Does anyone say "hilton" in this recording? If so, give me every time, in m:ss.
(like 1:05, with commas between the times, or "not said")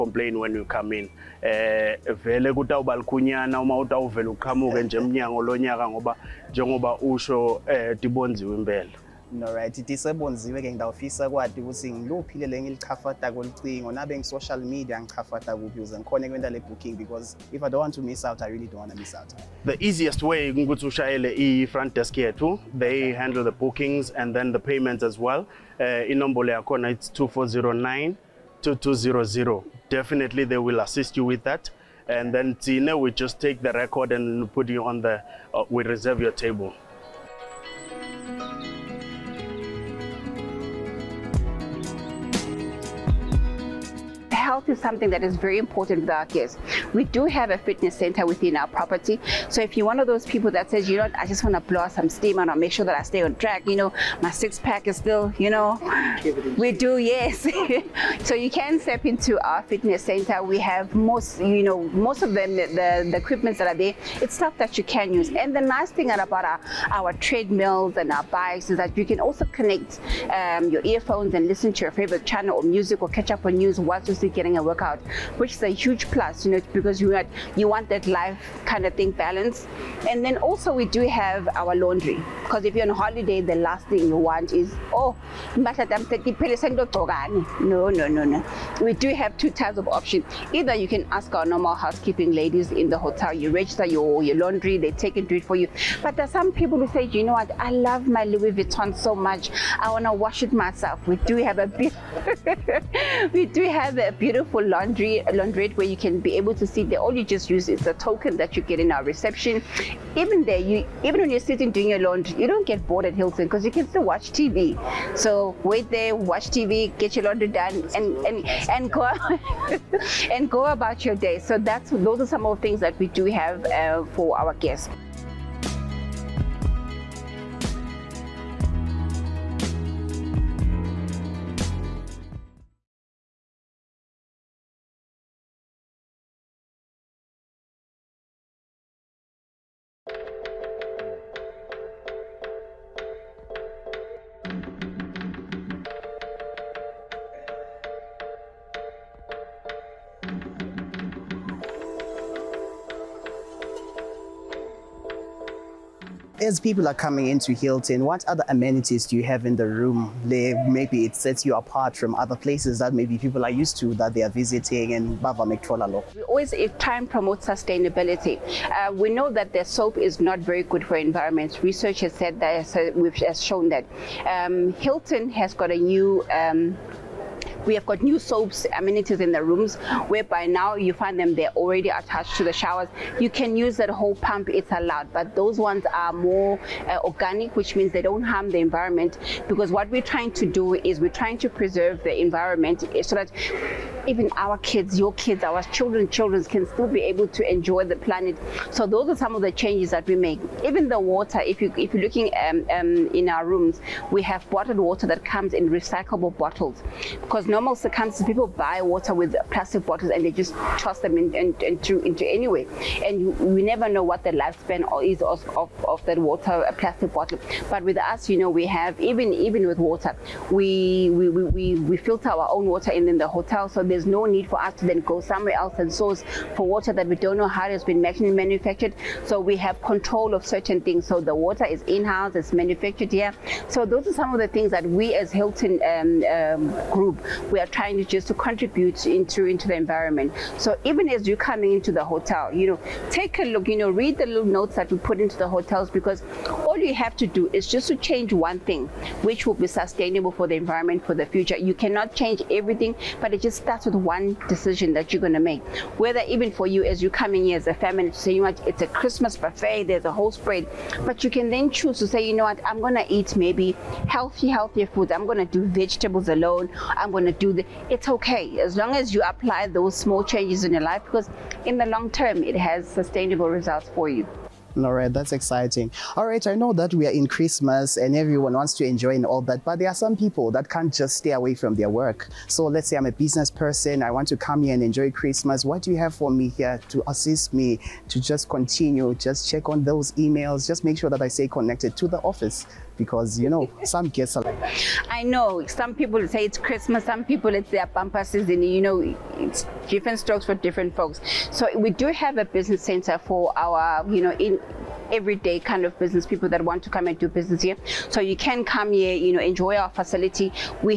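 1:53, 2:37, 2:54, 3:55.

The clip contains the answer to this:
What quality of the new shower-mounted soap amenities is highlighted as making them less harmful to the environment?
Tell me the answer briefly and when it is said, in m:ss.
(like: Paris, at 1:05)
Organic, at 3:07.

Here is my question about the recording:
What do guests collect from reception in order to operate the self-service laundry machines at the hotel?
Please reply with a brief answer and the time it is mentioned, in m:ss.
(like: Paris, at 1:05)
A token, at 1:47.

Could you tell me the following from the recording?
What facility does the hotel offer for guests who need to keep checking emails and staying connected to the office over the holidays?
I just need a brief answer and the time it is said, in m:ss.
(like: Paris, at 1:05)
A business center, at 5:02.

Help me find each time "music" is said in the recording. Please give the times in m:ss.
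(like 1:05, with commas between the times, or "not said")
1:12.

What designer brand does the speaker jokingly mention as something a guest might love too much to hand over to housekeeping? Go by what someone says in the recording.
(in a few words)
Louis Vuitton.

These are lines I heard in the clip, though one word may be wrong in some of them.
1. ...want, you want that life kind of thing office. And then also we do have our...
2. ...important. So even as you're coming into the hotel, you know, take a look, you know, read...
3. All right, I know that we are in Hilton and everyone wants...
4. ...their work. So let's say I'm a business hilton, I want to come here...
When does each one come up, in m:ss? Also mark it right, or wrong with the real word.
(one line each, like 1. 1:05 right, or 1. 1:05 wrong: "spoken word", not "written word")
1. 1:17 wrong: "balance", not "office"
2. 3:59 wrong: "environment", not "important"
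3. 4:36 wrong: "Christmas", not "Hilton"
4. 4:41 wrong: "person", not "hilton".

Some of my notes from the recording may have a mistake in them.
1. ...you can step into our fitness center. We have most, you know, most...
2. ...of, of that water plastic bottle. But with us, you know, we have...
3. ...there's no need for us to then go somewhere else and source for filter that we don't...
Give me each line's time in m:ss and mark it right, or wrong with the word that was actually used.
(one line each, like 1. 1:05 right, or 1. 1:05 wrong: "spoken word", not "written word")
1. 0:58 right
2. 3:35 right
3. 3:43 wrong: "water", not "filter".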